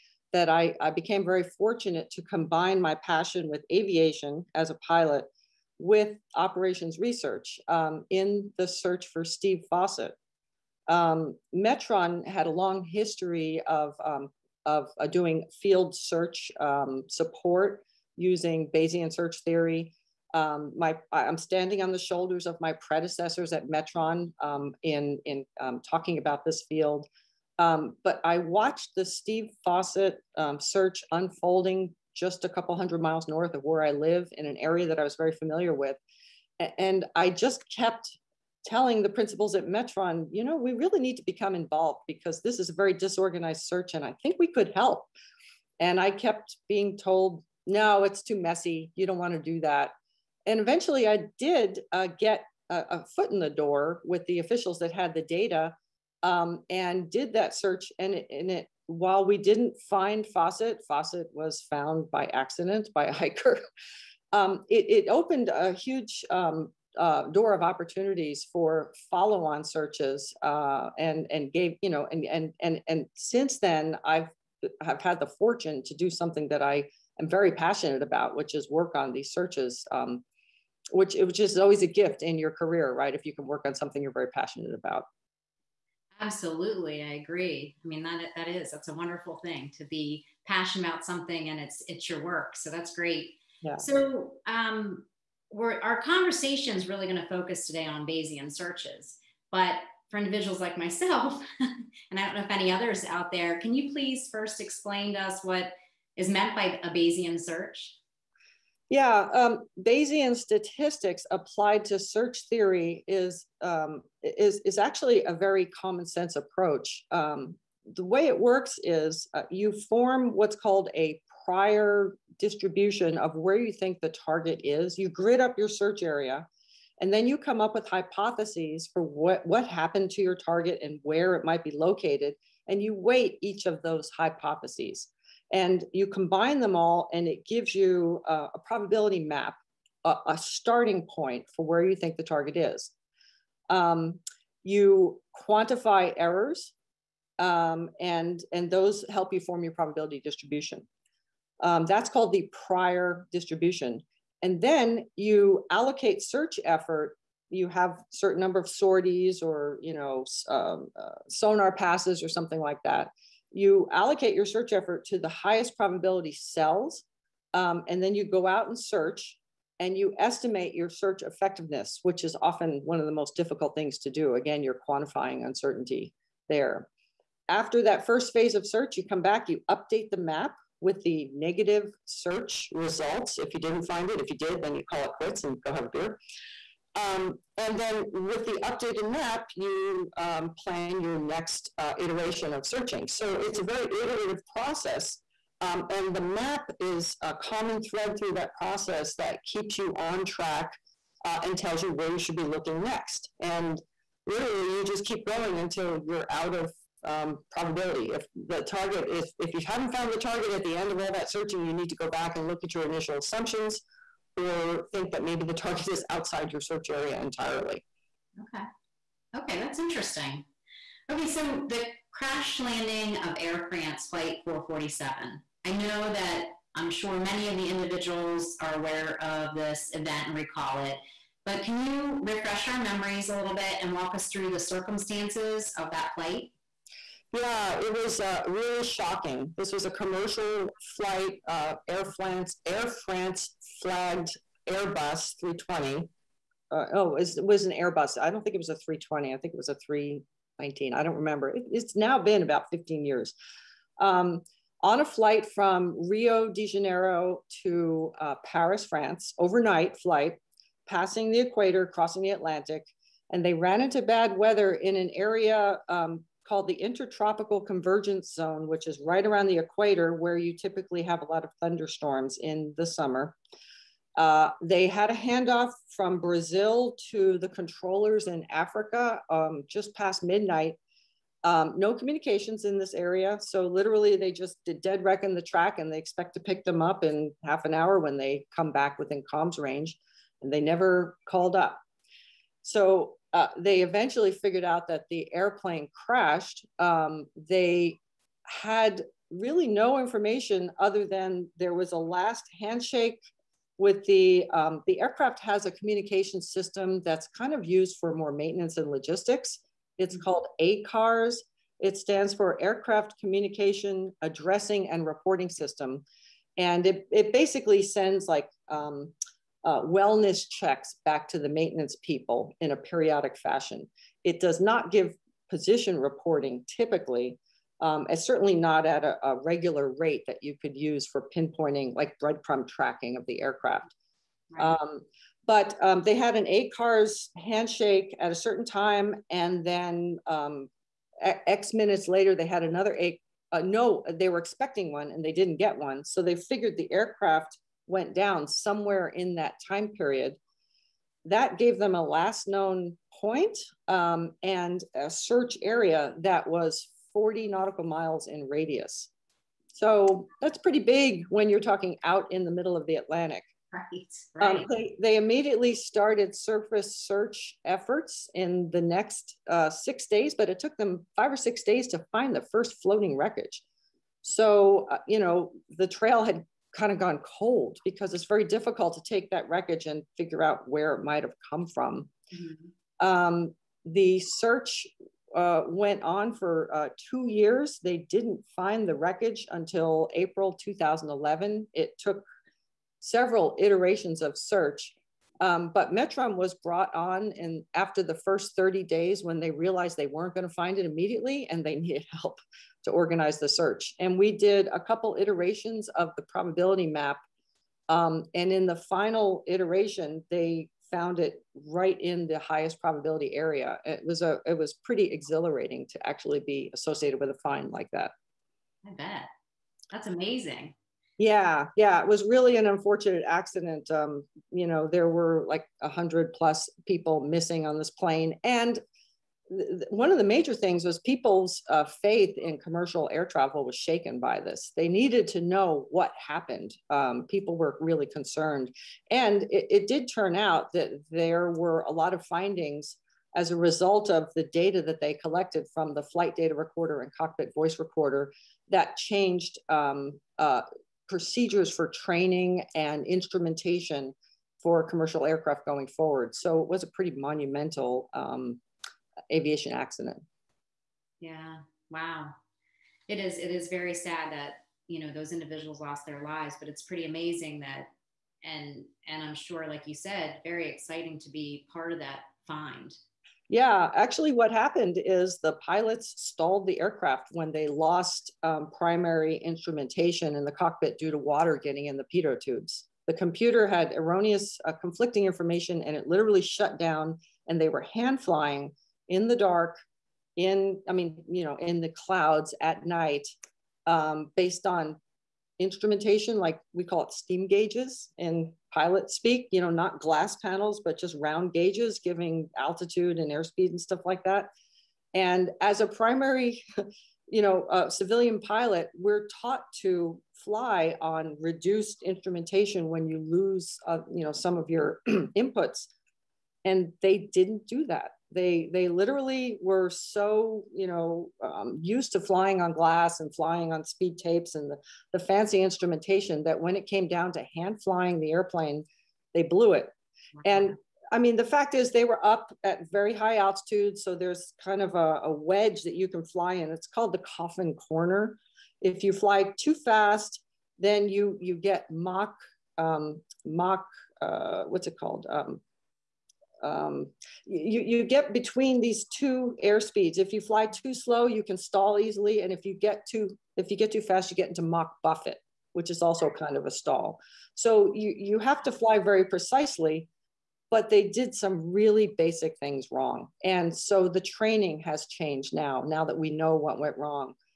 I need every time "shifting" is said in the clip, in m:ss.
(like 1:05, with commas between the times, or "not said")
not said.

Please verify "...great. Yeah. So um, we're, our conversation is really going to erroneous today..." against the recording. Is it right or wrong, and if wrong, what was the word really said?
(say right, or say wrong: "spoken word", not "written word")
wrong: "focus", not "erroneous".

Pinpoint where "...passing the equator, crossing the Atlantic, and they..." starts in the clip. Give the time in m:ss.
4:20.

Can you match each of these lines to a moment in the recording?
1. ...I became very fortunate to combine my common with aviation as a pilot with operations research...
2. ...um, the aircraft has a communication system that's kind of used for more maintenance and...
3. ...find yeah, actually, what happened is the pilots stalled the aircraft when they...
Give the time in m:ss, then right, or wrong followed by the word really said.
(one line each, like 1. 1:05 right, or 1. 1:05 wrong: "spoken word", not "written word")
1. 0:00 wrong: "passion", not "common"
2. 5:04 right
3. 7:52 right.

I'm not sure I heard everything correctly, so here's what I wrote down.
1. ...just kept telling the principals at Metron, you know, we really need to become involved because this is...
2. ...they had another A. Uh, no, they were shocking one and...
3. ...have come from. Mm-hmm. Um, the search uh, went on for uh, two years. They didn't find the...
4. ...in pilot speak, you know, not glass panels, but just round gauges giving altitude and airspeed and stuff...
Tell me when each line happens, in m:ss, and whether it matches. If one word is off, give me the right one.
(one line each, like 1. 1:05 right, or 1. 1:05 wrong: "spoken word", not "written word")
1. 0:37 right
2. 5:42 wrong: "expecting", not "shocking"
3. 6:21 right
4. 8:18 right.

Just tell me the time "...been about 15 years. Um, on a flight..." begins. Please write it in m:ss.
4:12.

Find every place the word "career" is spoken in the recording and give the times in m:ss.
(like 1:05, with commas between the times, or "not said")
1:22.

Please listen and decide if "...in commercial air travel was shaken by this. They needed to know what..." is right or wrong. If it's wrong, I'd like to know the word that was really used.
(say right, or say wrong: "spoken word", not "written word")
right.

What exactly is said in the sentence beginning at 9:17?
So you, you have to fly very precisely, but they did some really basic things wrong.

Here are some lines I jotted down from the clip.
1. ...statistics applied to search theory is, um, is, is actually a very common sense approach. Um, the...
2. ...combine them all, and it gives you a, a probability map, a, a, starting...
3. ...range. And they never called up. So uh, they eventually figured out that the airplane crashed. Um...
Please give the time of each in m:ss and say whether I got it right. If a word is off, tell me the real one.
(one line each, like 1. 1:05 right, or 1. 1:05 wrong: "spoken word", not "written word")
1. 1:50 right
2. 2:16 right
3. 4:49 right.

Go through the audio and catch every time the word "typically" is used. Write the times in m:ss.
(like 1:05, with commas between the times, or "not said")
4:30, 5:26.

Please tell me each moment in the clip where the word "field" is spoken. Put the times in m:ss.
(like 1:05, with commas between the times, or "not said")
0:15, 0:26.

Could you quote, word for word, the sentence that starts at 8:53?
So there's kind of a, a, wedge that you can fly in.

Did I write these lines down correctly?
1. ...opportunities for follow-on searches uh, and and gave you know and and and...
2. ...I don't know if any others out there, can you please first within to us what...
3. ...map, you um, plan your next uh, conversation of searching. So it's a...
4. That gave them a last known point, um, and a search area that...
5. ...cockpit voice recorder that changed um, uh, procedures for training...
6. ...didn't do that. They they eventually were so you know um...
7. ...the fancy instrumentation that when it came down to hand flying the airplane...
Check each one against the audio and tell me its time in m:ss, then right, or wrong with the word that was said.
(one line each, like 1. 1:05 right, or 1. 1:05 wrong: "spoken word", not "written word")
1. 1:07 right
2. 1:42 wrong: "explain", not "within"
3. 3:09 wrong: "iteration", not "conversation"
4. 5:51 right
5. 7:27 right
6. 8:37 wrong: "literally", not "eventually"
7. 8:45 right.